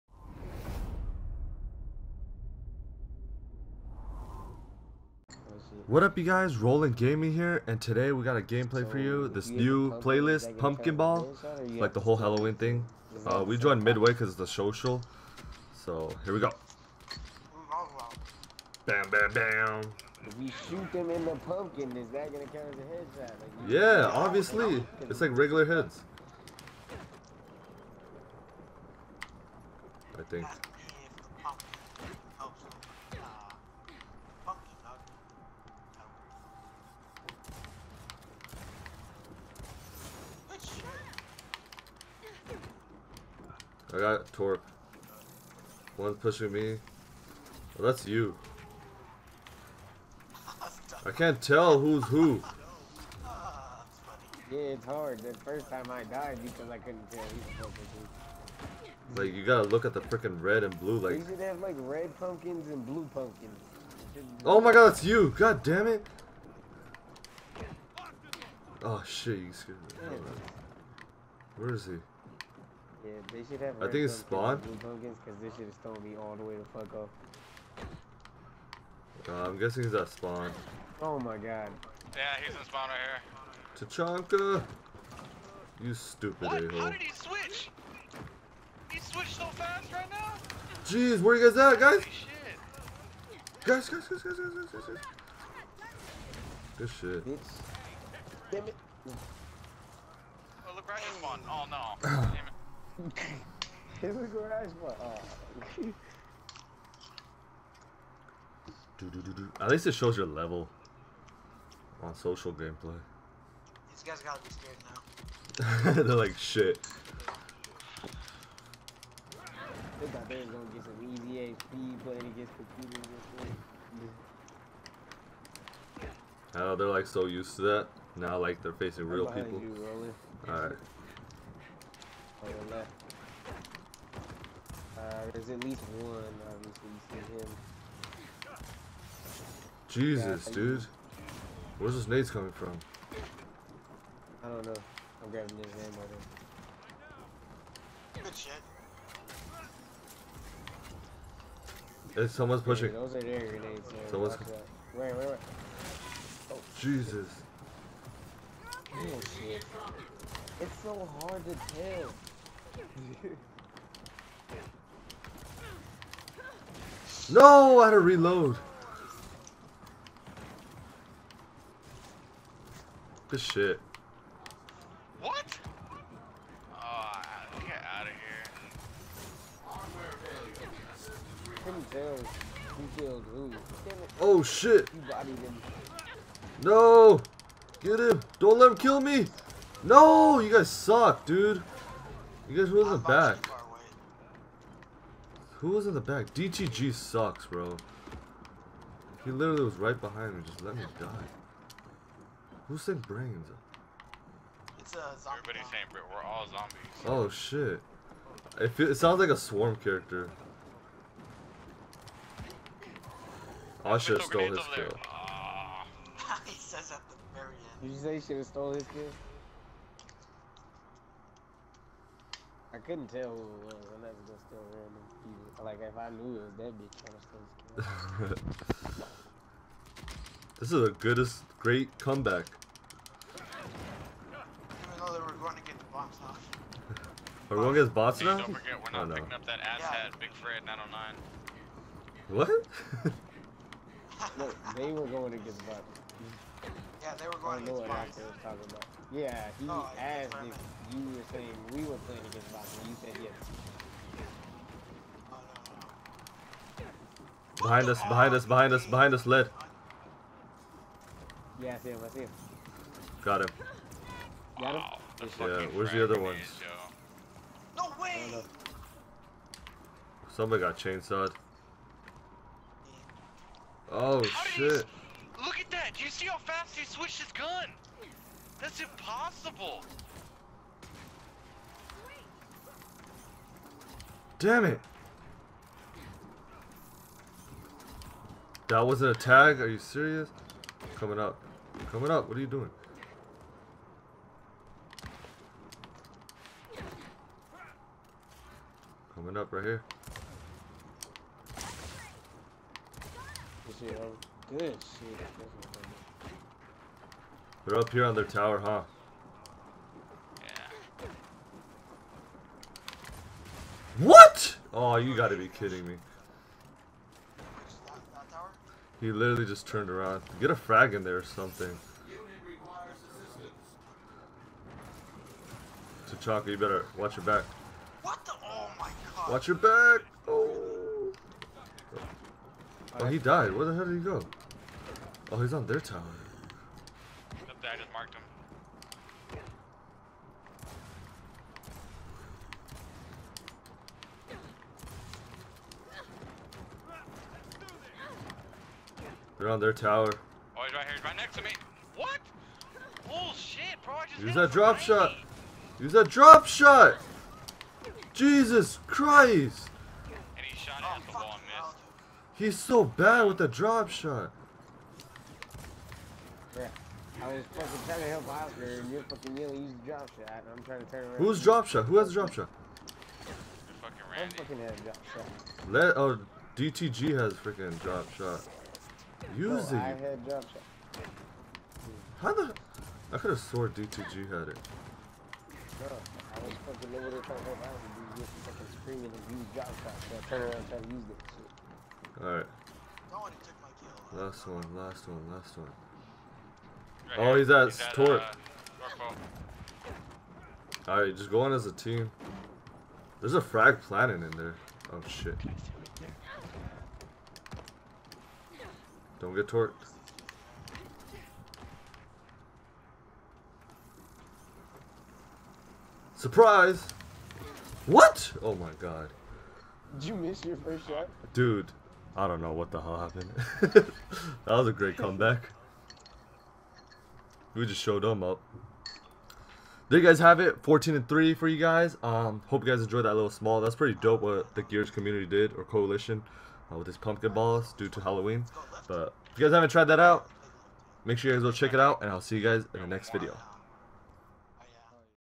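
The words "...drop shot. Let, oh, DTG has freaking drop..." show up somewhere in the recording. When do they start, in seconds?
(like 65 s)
374 s.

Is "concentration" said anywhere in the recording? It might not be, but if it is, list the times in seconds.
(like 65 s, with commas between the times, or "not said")
not said.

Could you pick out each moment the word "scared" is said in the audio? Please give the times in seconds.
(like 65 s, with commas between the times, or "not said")
69 s, 114 s, 228 s.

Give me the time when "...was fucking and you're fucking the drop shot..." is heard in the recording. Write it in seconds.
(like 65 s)
367 s.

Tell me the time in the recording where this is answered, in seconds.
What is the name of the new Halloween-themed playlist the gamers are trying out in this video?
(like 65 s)
10 s.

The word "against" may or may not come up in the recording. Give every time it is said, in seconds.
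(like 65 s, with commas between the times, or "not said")
122 s, 247 s, 252 s.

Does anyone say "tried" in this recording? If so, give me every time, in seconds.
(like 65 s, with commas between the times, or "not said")
390 s, 439 s.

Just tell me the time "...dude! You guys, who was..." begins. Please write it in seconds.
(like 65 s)
191 s.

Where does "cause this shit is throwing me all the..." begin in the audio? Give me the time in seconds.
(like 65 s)
74 s.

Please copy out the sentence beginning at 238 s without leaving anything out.
Don't forget, we're not oh, no.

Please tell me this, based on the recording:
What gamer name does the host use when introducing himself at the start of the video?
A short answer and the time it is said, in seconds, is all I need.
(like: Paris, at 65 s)
Rollin Gaming, at 6 s.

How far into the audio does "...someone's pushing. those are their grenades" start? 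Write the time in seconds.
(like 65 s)
152 s.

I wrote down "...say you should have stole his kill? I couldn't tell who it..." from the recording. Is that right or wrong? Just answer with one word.
right.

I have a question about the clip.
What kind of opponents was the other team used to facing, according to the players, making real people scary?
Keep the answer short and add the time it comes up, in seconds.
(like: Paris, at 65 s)
Computers, at 122 s.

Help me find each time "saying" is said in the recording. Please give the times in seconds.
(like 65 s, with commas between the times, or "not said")
205 s, 251 s.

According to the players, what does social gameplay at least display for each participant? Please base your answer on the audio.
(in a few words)
Your level.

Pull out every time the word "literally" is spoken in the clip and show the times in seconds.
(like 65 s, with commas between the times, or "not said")
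199 s, 319 s.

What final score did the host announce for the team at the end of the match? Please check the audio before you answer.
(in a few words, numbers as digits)
14 and 3.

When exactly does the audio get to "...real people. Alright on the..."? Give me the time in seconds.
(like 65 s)
129 s.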